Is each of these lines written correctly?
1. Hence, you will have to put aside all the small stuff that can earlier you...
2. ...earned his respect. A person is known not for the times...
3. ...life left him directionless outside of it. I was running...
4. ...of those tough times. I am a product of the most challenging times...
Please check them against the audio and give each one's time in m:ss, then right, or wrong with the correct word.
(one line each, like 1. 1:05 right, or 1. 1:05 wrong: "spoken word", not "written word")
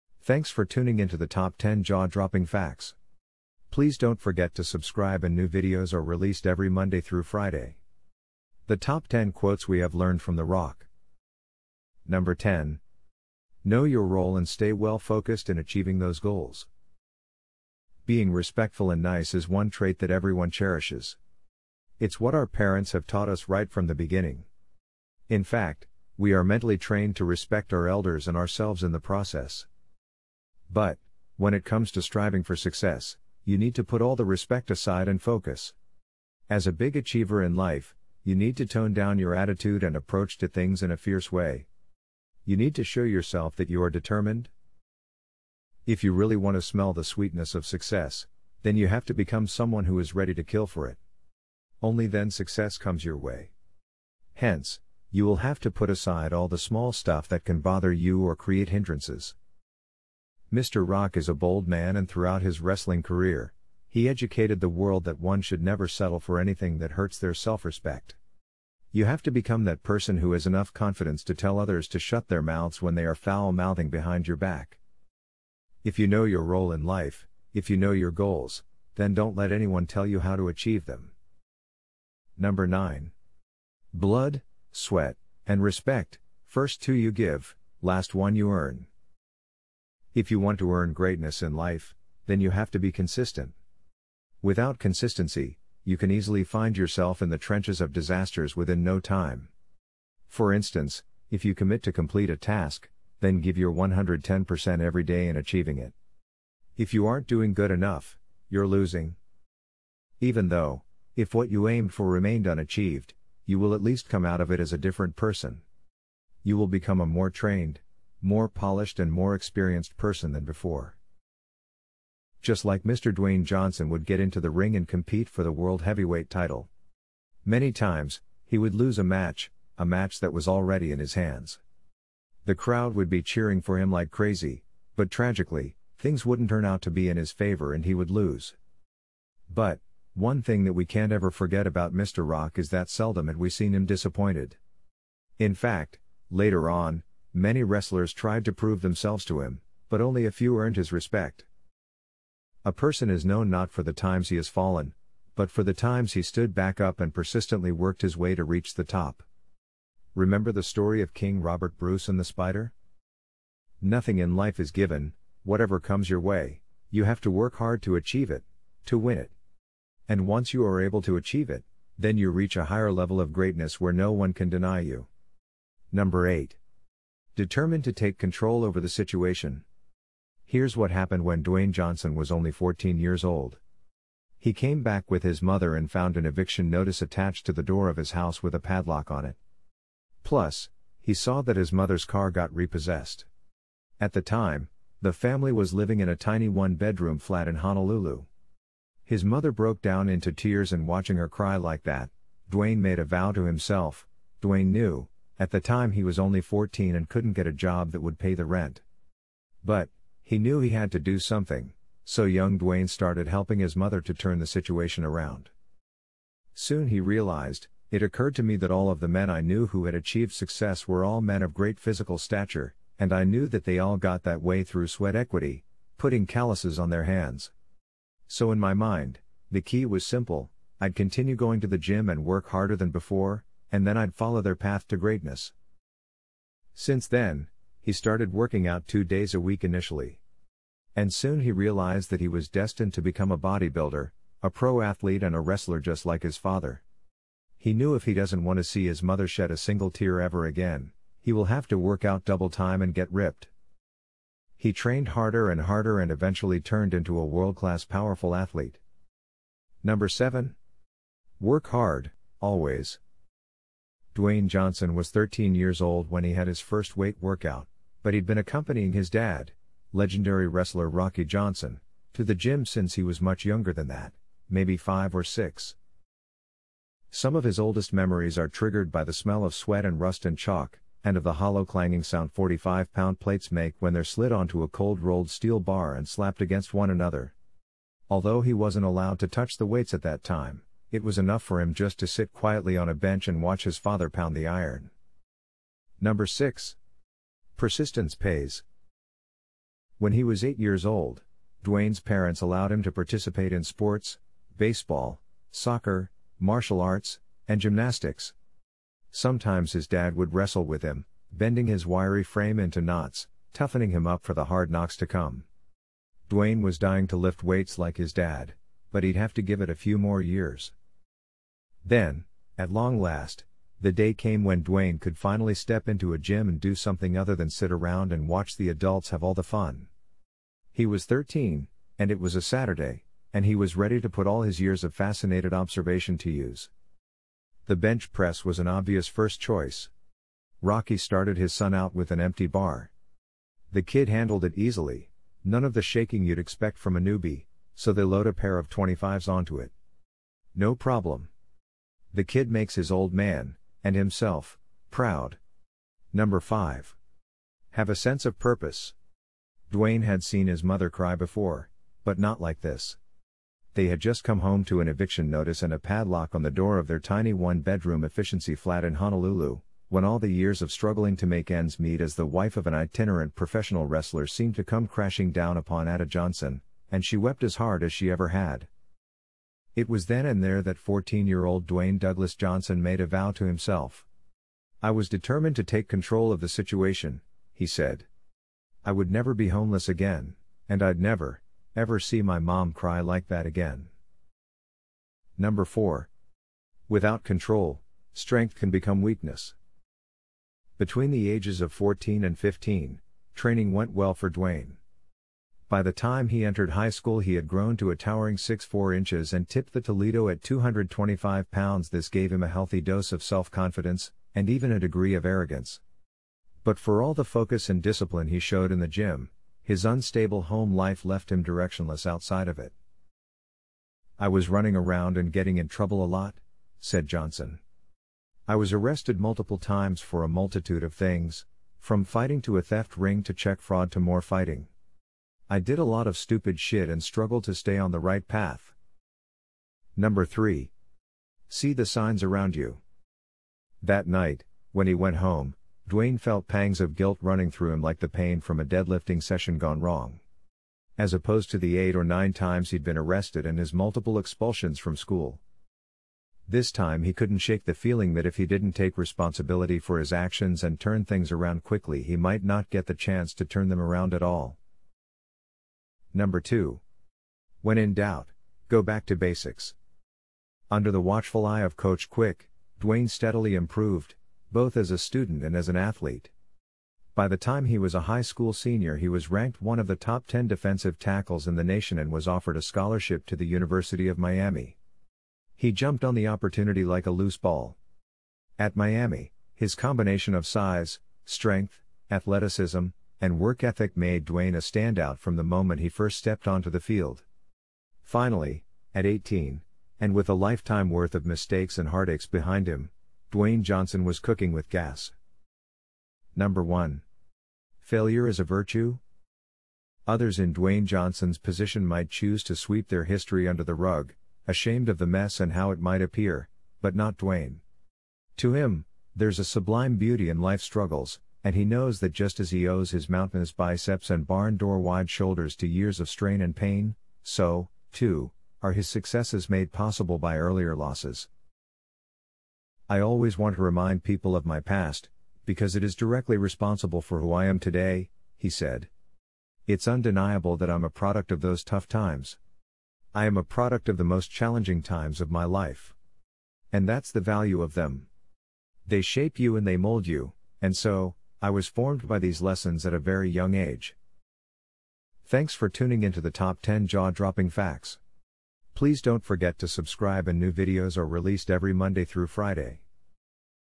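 1. 0:54 wrong: "bother", not "earlier"
2. 2:30 right
3. 7:00 right
4. 9:01 right.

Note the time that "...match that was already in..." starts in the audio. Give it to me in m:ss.
2:09.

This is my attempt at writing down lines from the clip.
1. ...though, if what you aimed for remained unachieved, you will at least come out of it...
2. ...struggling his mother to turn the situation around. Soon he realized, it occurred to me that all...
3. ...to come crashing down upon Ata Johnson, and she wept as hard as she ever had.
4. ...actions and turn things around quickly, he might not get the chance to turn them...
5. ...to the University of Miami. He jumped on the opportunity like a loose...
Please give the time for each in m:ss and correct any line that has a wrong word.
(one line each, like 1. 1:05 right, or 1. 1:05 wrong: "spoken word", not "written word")
1. 1:50 right
2. 3:33 wrong: "helping", not "struggling"
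3. 6:14 right
4. 7:40 right
5. 8:03 right.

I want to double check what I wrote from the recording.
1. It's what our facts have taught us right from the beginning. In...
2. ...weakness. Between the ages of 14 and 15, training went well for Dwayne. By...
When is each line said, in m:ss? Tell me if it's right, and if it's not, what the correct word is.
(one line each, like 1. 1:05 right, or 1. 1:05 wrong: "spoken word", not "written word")
1. 0:21 wrong: "parents", not "facts"
2. 6:39 right.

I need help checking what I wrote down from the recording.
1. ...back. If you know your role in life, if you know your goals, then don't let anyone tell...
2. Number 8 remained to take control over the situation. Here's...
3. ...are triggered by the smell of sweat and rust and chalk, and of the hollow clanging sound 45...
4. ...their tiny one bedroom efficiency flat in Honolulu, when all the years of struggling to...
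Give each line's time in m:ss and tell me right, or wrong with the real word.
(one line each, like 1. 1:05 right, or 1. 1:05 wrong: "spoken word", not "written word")
1. 1:14 right
2. 2:55 wrong: "determined", not "remained"
3. 4:38 right
4. 6:06 right.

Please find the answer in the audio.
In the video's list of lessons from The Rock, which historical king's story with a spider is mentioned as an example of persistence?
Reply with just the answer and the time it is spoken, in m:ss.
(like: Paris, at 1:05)
Robert Bruce, at 2:41.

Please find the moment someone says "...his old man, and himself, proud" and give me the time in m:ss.
5:52.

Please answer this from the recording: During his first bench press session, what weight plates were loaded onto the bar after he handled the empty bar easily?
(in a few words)
a pair of 25s.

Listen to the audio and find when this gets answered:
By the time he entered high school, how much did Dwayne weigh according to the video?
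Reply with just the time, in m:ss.
6:50.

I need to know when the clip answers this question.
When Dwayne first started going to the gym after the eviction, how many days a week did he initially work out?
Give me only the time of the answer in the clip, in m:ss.
3:58.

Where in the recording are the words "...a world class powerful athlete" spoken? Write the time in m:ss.
4:17.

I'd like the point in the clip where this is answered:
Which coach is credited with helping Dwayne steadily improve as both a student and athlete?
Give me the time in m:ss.
7:51.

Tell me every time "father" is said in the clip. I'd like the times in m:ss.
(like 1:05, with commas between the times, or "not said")
4:06, 4:53.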